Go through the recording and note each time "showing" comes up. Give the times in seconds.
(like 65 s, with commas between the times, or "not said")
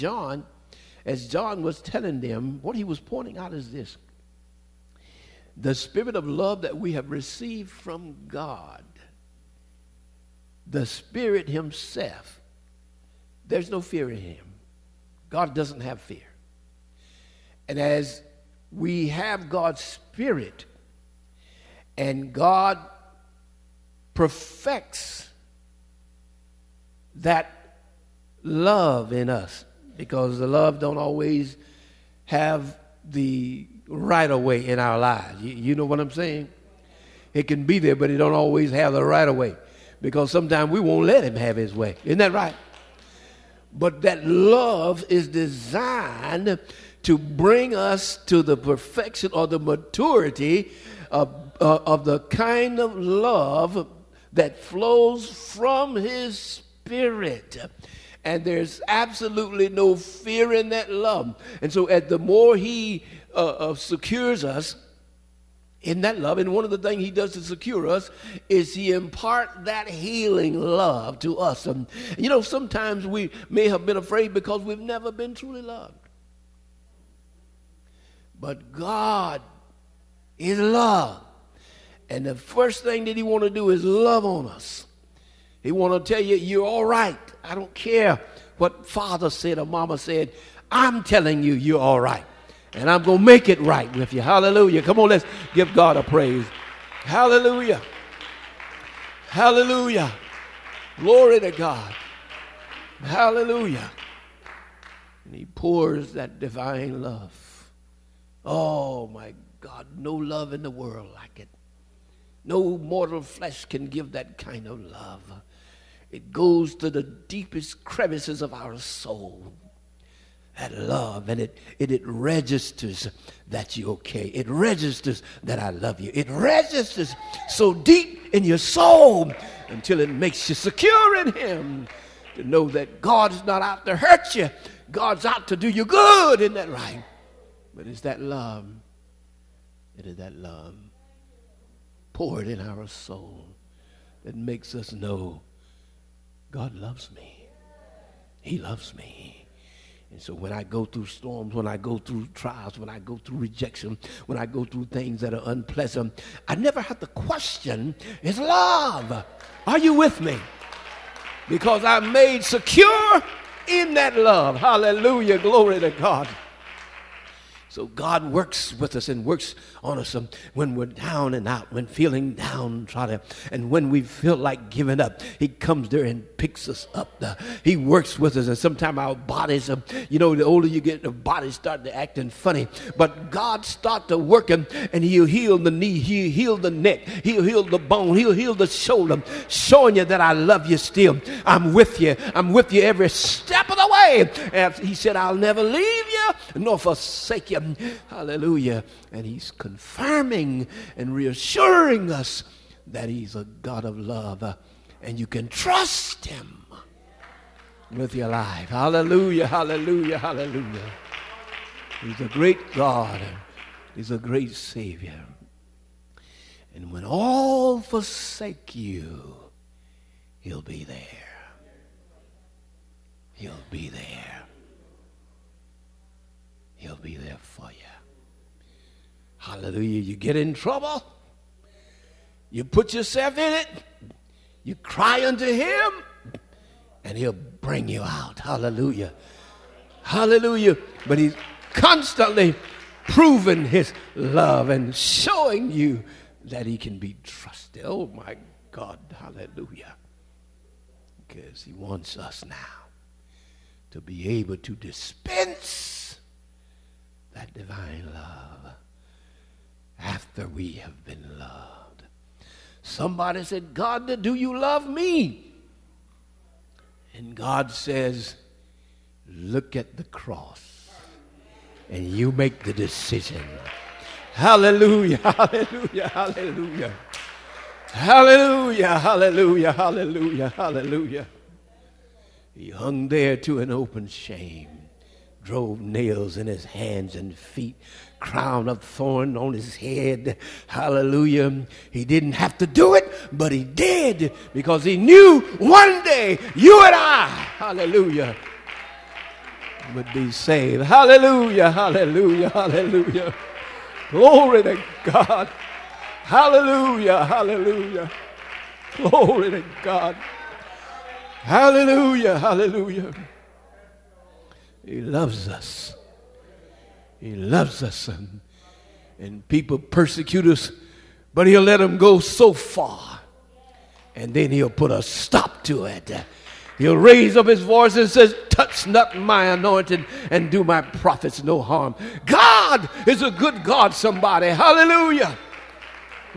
189 s, 244 s.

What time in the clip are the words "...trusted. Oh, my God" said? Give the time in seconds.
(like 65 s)
247 s.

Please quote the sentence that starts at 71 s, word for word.
And you know, sometimes we may have been afraid because we've never been truly loved.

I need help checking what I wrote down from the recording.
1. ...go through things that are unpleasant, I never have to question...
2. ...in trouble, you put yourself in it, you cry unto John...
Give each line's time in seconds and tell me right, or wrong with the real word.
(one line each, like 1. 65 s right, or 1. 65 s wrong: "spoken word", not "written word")
1. 154 s right
2. 230 s wrong: "Him", not "John".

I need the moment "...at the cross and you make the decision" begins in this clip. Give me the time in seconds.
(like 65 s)
269 s.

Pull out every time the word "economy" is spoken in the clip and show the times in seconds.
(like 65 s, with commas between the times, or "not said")
not said.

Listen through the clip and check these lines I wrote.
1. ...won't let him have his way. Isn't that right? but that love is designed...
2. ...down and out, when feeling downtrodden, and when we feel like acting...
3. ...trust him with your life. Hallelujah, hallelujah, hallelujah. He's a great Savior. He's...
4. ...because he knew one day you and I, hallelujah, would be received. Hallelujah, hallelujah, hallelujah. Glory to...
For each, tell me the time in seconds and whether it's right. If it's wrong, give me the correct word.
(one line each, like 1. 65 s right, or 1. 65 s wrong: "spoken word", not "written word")
1. 40 s right
2. 170 s wrong: "giving", not "acting"
3. 205 s wrong: "God", not "Savior"
4. 294 s wrong: "saved", not "received".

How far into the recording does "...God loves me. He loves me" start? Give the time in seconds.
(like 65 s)
146 s.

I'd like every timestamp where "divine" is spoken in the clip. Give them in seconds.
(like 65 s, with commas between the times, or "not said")
106 s, 257 s.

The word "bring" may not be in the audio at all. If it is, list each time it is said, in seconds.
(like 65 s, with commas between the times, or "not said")
47 s, 237 s.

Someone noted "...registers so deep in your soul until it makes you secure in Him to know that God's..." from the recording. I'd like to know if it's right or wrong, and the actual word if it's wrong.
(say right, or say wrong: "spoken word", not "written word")
right.